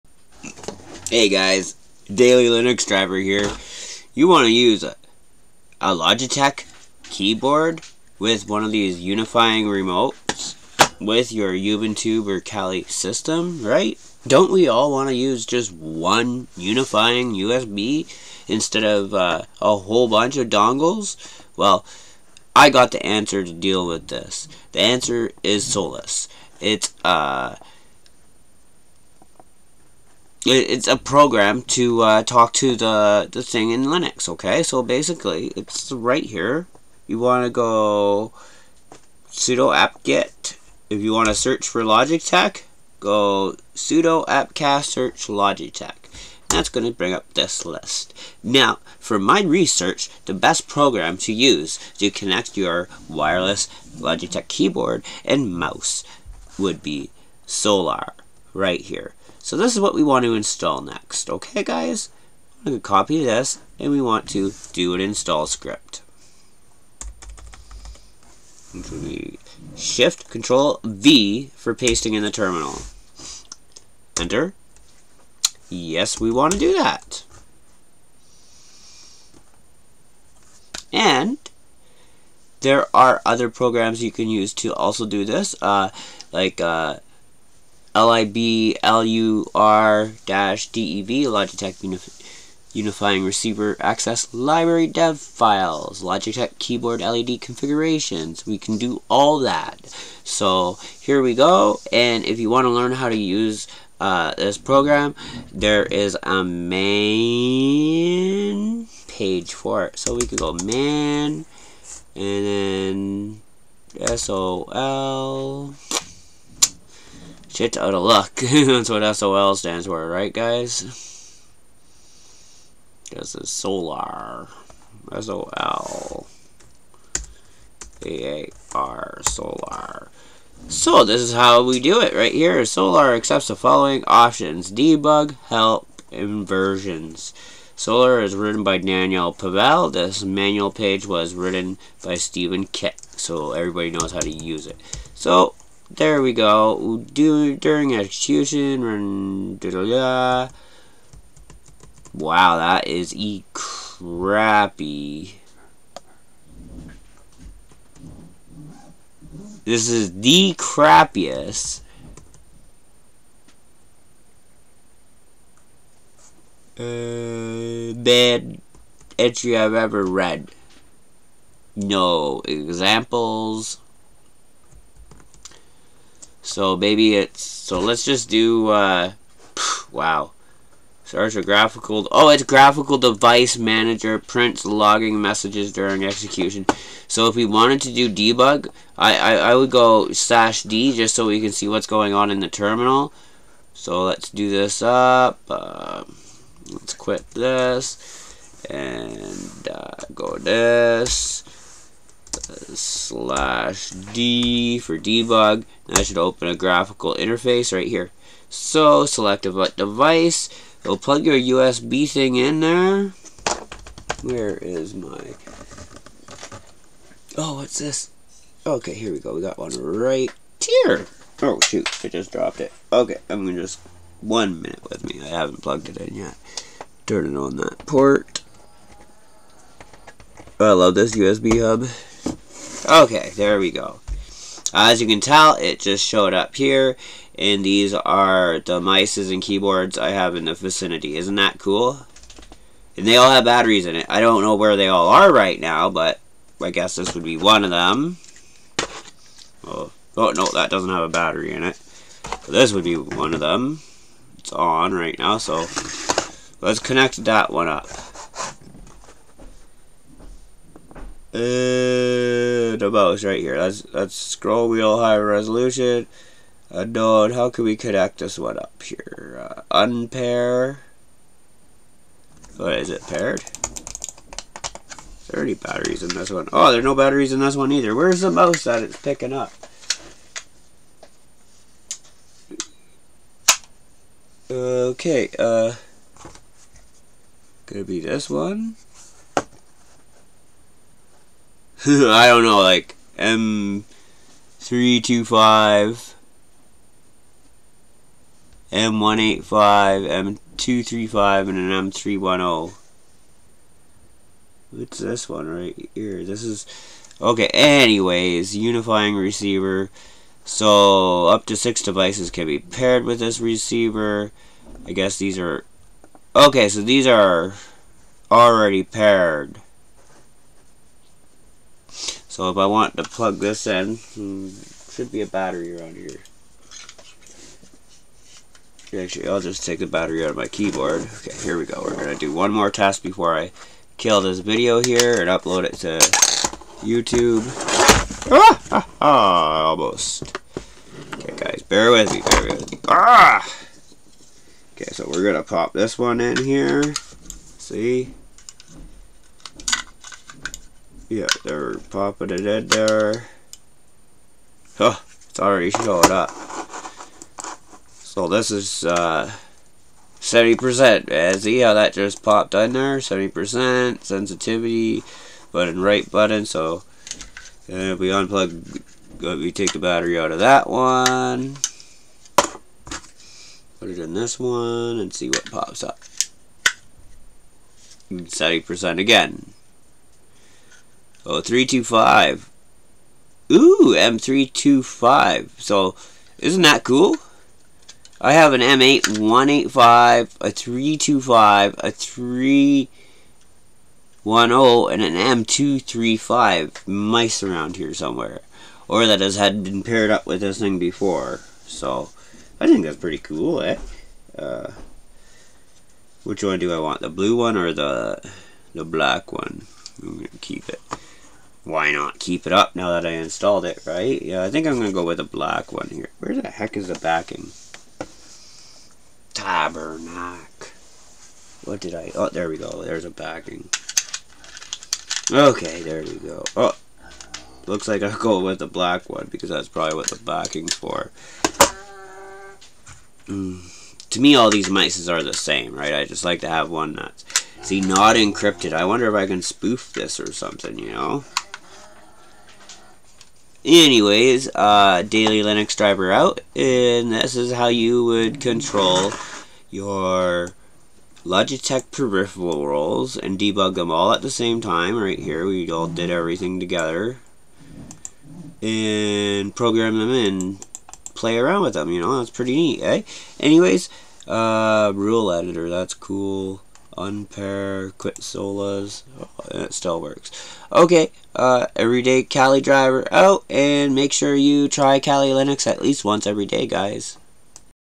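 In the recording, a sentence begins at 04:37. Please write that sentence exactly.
Where's the mouse that it's picking up?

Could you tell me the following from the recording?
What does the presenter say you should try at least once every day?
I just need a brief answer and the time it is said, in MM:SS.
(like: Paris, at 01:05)
Kali Linux, at 07:54.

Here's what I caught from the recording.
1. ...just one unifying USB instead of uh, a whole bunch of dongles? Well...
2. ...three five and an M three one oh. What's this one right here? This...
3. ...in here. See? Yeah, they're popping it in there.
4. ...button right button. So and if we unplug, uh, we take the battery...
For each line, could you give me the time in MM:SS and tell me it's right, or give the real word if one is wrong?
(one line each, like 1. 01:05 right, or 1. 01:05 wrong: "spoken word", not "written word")
1. 00:15 right
2. 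05:00 right
3. 05:46 right
4. 06:05 right.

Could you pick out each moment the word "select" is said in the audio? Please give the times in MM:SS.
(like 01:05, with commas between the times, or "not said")
03:29.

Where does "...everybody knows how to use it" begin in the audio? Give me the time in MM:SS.
02:23.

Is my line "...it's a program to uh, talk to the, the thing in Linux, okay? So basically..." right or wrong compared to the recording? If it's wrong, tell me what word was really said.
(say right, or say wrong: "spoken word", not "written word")
right.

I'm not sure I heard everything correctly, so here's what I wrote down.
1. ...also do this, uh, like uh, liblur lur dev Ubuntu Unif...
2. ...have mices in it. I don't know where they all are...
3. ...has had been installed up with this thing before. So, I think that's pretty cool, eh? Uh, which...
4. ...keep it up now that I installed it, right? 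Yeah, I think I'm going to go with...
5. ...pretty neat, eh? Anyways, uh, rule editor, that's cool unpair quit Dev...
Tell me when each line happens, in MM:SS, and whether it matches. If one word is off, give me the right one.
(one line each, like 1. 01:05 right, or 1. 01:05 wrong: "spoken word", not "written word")
1. 01:24 wrong: "Logitech", not "Ubuntu"
2. 04:03 wrong: "batteries", not "mices"
3. 06:39 wrong: "paired", not "installed"
4. 06:52 right
5. 07:42 wrong: "Solaar", not "Dev".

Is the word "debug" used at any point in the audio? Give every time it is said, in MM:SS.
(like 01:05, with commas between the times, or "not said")
02:14, 03:08, 03:24, 07:33.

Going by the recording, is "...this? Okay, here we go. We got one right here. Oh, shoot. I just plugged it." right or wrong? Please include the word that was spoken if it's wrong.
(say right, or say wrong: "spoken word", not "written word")
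wrong: "dropped", not "plugged".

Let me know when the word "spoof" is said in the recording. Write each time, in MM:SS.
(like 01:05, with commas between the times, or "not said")
07:19.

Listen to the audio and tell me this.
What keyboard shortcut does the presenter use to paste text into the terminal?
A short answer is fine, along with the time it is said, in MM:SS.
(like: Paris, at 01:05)
Shift Control V, at 01:09.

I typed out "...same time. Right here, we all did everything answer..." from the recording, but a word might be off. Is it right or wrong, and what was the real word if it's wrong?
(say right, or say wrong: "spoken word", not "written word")
wrong: "together", not "answer".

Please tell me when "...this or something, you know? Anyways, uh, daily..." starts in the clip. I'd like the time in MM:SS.
07:19.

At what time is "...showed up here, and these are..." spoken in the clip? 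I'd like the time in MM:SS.
03:56.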